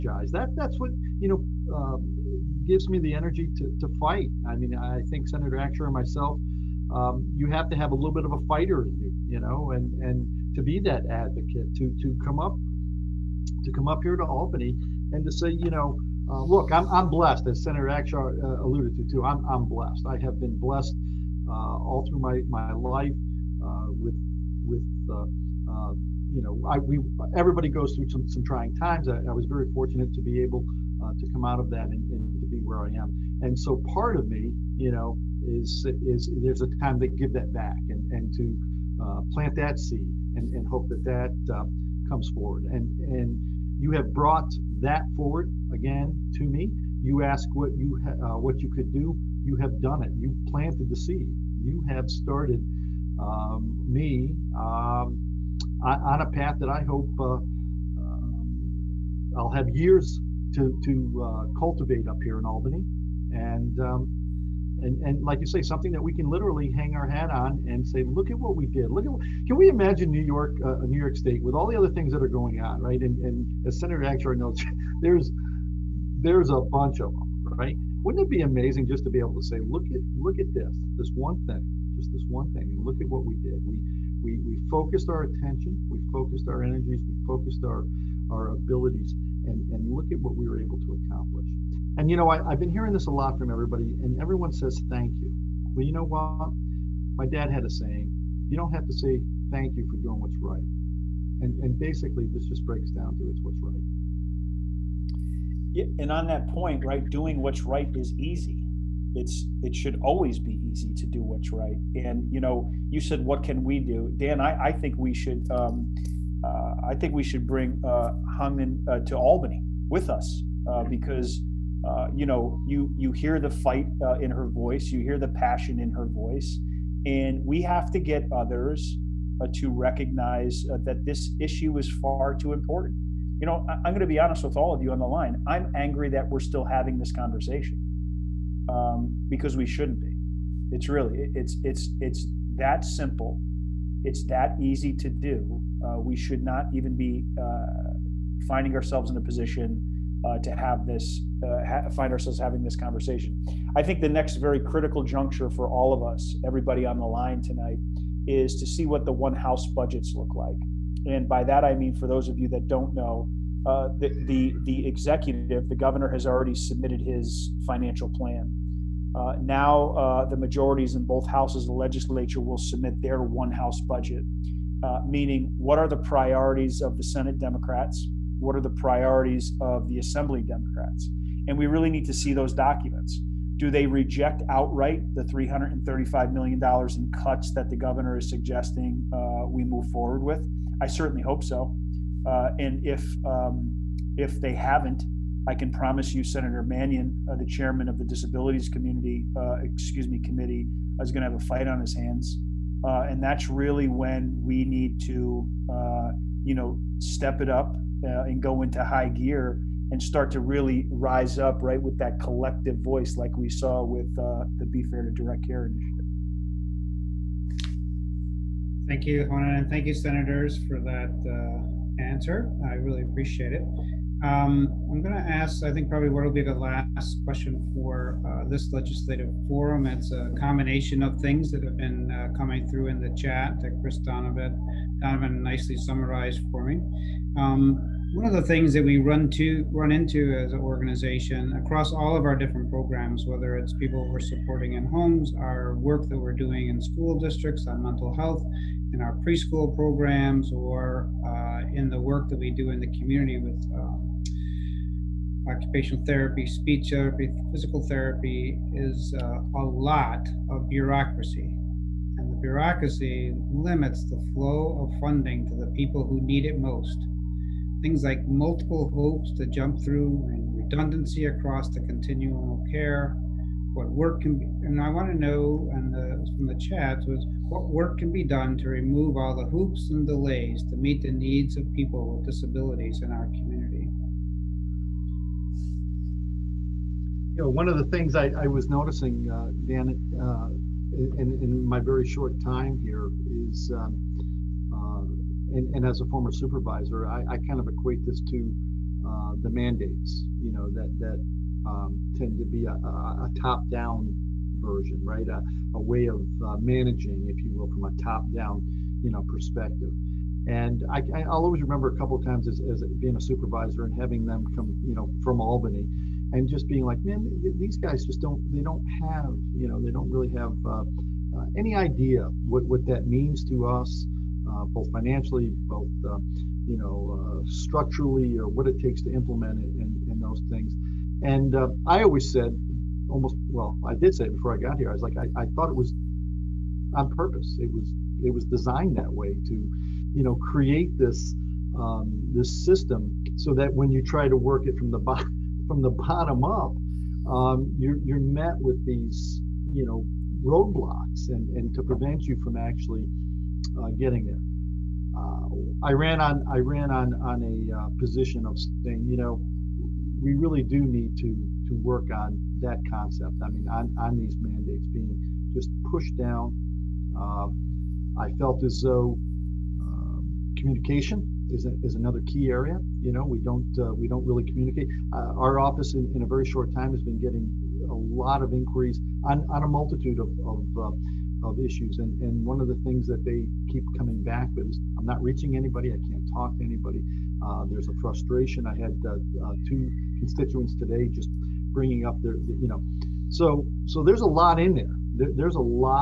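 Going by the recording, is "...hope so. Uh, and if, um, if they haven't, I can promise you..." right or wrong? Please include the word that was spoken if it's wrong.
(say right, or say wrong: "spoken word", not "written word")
right.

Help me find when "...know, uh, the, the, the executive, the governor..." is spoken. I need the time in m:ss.
2:42.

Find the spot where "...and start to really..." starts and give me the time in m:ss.
3:29.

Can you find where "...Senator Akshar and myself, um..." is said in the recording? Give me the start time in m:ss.
0:05.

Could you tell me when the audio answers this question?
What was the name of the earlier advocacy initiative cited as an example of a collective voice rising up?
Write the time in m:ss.
3:34.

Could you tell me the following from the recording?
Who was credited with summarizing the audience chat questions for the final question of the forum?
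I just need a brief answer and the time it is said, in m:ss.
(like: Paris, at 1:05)
Chris Donovan, at 3:53.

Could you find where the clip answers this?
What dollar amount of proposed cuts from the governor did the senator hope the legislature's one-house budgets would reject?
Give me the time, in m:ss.
3:05.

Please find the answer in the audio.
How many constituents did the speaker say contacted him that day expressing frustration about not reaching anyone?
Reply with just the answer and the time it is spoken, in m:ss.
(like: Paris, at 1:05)
2, at 6:29.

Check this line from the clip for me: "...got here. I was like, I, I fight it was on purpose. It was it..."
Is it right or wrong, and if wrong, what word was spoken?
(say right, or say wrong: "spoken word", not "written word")
wrong: "thought", not "fight".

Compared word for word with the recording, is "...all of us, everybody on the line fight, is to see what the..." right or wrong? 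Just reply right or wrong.
wrong.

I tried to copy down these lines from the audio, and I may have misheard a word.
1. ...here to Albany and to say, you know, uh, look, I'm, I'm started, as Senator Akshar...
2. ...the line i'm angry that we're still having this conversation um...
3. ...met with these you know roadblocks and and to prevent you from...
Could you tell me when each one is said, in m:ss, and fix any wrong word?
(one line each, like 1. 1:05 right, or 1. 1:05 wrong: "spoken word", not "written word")
1. 0:14 wrong: "blessed", not "started"
2. 2:14 right
3. 5:48 right.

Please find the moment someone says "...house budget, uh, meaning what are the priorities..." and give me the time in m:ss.
2:53.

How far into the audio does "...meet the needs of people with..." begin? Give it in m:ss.
4:40.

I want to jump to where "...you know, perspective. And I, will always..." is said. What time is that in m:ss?
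5:09.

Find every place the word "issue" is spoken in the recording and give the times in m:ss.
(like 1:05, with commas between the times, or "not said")
2:11, 6:21.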